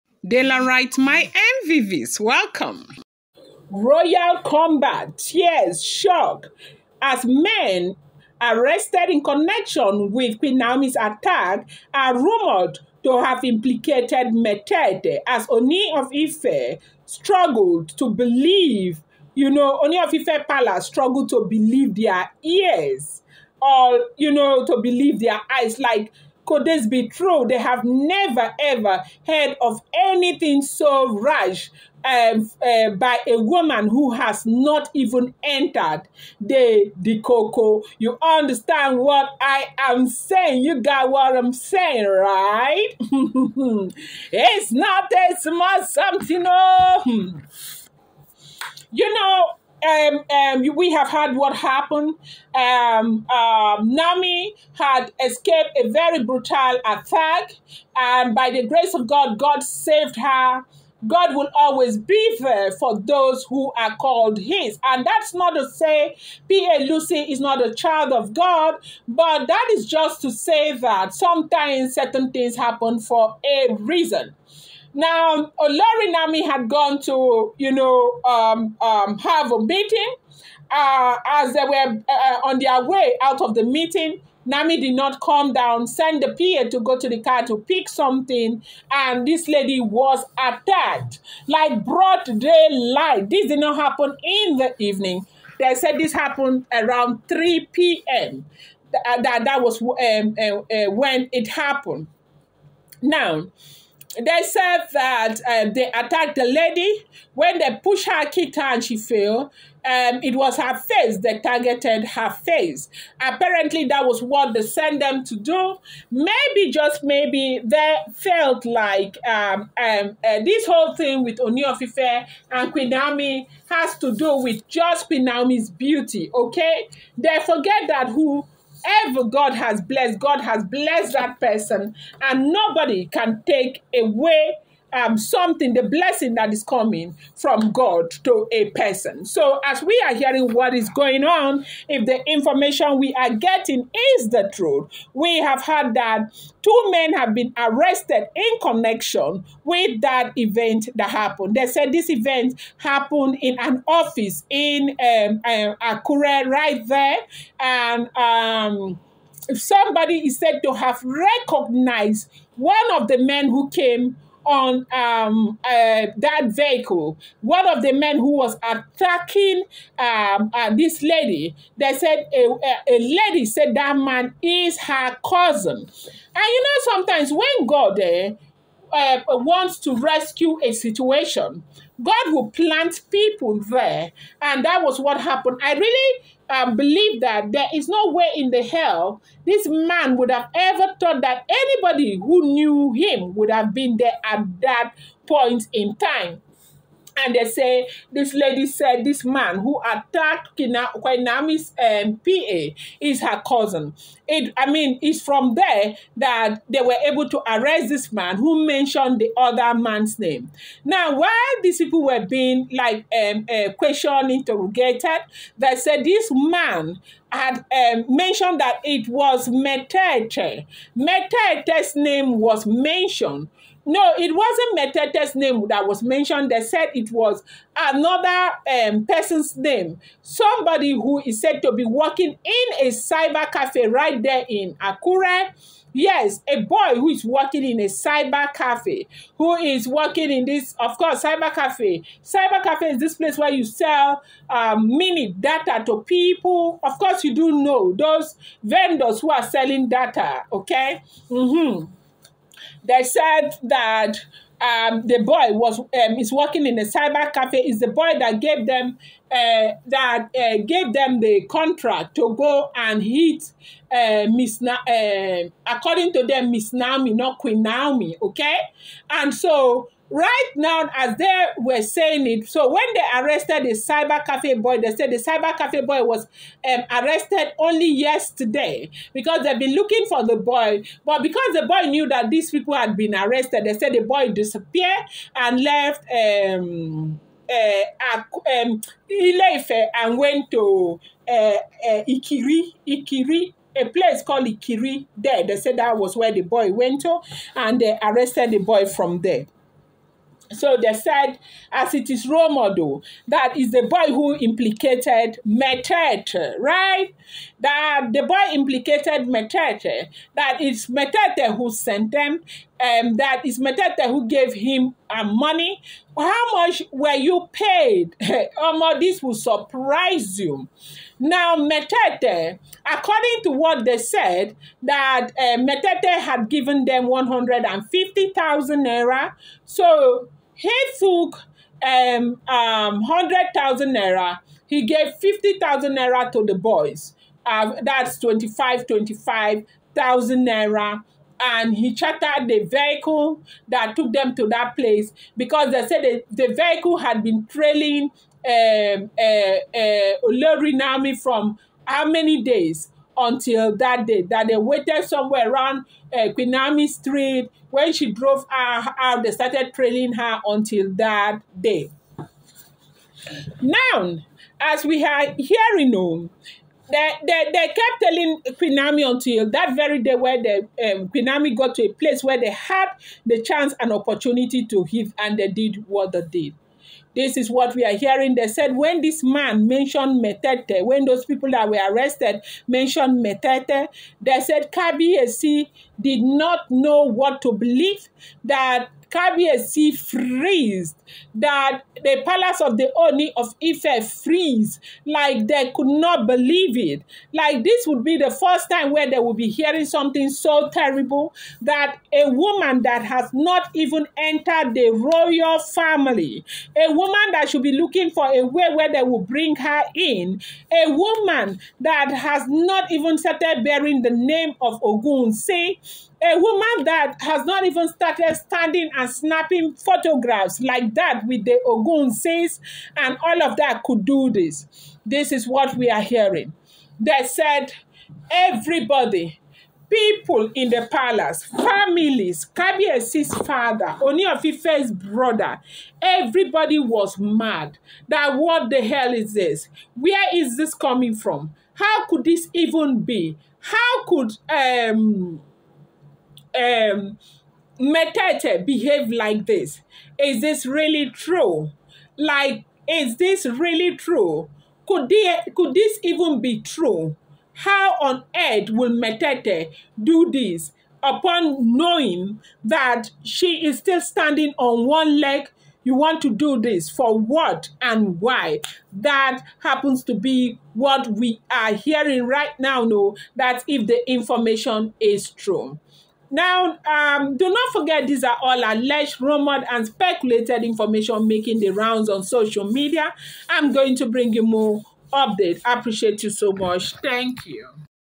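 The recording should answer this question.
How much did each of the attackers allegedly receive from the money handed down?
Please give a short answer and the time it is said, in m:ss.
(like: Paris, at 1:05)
25,000 naira, at 5:38.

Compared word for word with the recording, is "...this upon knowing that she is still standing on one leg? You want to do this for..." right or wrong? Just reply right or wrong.
right.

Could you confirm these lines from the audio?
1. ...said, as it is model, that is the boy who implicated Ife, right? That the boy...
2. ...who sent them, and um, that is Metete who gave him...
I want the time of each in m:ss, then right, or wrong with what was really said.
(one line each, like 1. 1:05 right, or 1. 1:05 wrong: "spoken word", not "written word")
1. 5:00 wrong: "Metete", not "Ife"
2. 5:11 right.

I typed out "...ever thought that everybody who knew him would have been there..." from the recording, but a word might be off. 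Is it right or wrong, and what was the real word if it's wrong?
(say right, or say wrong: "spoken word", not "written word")
wrong: "anybody", not "everybody".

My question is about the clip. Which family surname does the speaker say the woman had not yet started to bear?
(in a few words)
Ogunwusi.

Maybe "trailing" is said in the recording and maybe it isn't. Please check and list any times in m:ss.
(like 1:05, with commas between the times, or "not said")
5:47, 5:59.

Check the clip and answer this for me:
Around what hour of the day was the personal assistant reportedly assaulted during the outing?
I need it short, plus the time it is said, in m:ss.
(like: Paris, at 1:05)
3 p.m., at 1:37.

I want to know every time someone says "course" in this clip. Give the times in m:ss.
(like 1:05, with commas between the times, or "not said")
4:00, 4:06.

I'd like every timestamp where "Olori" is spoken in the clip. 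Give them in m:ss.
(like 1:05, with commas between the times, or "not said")
1:15, 5:50.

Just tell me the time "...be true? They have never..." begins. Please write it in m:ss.
0:26.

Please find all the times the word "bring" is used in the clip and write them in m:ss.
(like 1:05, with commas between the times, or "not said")
6:49, 8:04.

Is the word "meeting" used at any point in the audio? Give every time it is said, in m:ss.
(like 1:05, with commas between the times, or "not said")
1:19, 1:23.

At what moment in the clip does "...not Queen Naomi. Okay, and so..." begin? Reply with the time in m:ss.
4:27.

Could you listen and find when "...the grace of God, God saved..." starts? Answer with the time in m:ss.
0:58.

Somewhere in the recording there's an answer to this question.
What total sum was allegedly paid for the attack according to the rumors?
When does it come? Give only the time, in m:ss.
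5:27.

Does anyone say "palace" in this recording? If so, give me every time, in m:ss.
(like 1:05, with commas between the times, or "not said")
0:20, 6:32, 7:10.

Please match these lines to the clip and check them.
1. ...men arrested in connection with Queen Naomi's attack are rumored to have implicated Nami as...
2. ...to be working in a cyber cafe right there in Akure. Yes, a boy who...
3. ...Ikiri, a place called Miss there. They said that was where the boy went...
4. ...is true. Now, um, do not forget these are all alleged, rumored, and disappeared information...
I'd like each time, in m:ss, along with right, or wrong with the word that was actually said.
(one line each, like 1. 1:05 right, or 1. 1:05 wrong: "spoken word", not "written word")
1. 0:07 wrong: "Metete", not "Nami"
2. 3:51 right
3. 4:52 wrong: "Ikiri", not "Miss"
4. 7:54 wrong: "speculated", not "disappeared".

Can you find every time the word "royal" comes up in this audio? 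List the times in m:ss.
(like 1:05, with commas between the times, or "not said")
0:03, 6:44.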